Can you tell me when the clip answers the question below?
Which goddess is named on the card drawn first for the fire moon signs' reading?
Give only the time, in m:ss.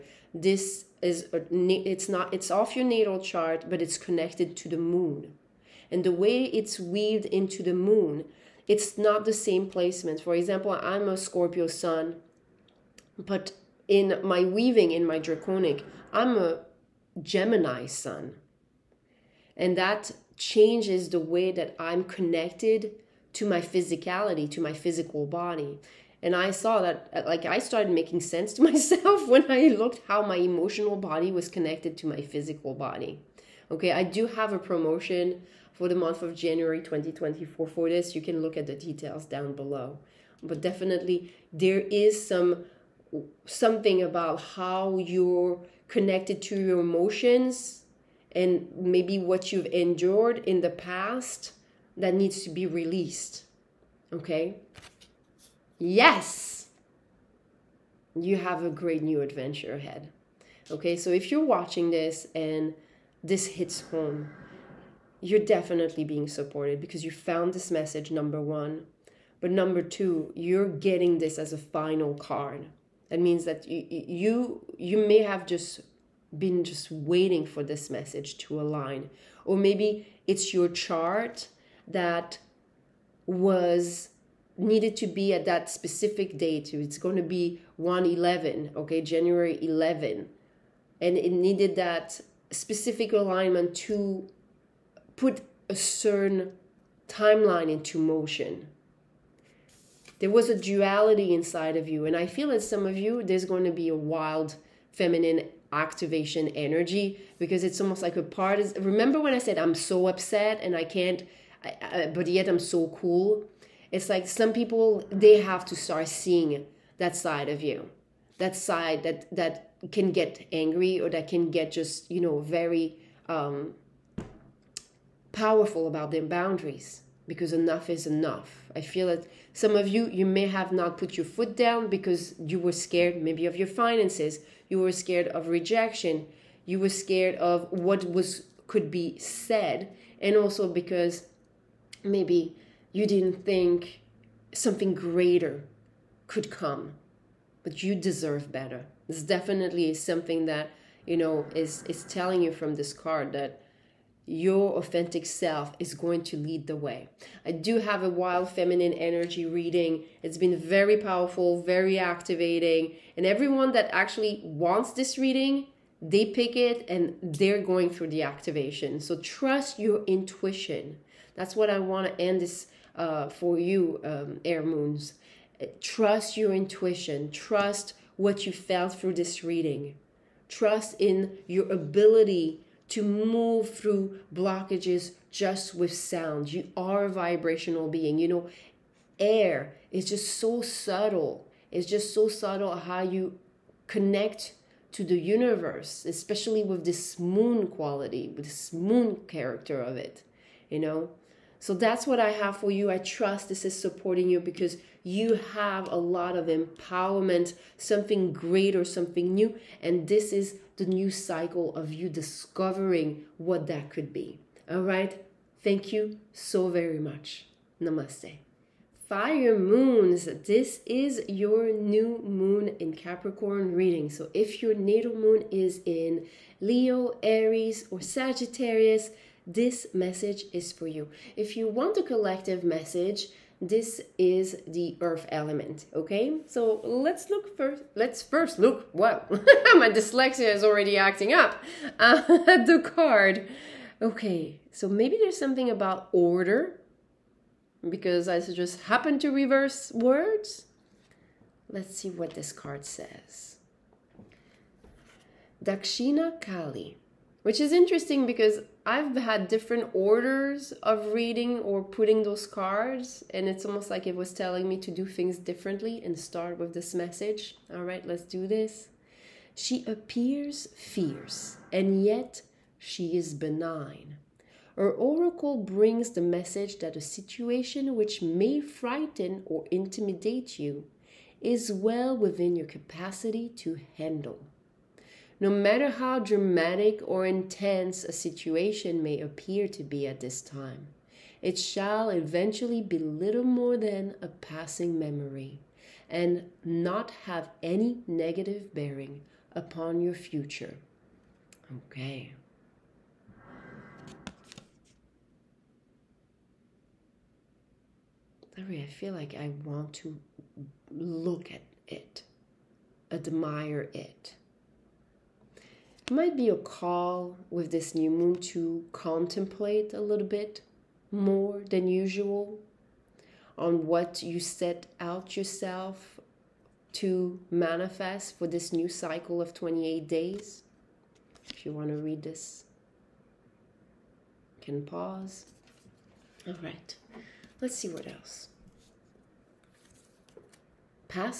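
4:15.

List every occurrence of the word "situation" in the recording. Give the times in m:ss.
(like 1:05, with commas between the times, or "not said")
4:37, 4:48.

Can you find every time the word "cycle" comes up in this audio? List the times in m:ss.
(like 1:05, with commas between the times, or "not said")
3:31, 5:28.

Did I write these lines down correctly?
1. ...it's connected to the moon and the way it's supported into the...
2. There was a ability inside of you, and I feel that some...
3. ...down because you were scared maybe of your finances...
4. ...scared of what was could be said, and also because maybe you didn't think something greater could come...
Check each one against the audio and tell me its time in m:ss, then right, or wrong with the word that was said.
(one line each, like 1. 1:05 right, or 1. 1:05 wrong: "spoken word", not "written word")
1. 0:03 wrong: "weaved", not "supported"
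2. 1:40 wrong: "duality", not "ability"
3. 2:11 right
4. 2:16 right.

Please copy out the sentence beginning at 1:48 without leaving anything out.
Remember when I said I'm so upset and I can't, I, I, but yet I'm so cool?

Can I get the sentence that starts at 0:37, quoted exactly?
For this, you can look at the details down below.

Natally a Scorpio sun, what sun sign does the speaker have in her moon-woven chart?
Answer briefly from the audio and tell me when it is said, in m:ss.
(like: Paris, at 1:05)
Gemini, at 0:17.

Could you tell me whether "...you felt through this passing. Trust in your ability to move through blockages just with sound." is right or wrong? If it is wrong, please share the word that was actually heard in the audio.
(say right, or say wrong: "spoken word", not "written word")
wrong: "reading", not "passing".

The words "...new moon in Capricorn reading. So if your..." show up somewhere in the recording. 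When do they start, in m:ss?
3:41.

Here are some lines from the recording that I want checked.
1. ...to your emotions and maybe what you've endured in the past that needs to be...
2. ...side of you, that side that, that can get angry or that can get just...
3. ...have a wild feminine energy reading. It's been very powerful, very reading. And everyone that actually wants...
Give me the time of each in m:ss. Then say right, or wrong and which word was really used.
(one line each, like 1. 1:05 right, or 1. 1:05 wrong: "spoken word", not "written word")
1. 0:46 right
2. 1:57 right
3. 2:37 wrong: "activating", not "reading".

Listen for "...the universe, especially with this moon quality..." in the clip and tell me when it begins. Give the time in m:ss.
3:15.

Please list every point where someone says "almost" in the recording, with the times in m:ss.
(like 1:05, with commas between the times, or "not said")
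1:47, 4:23.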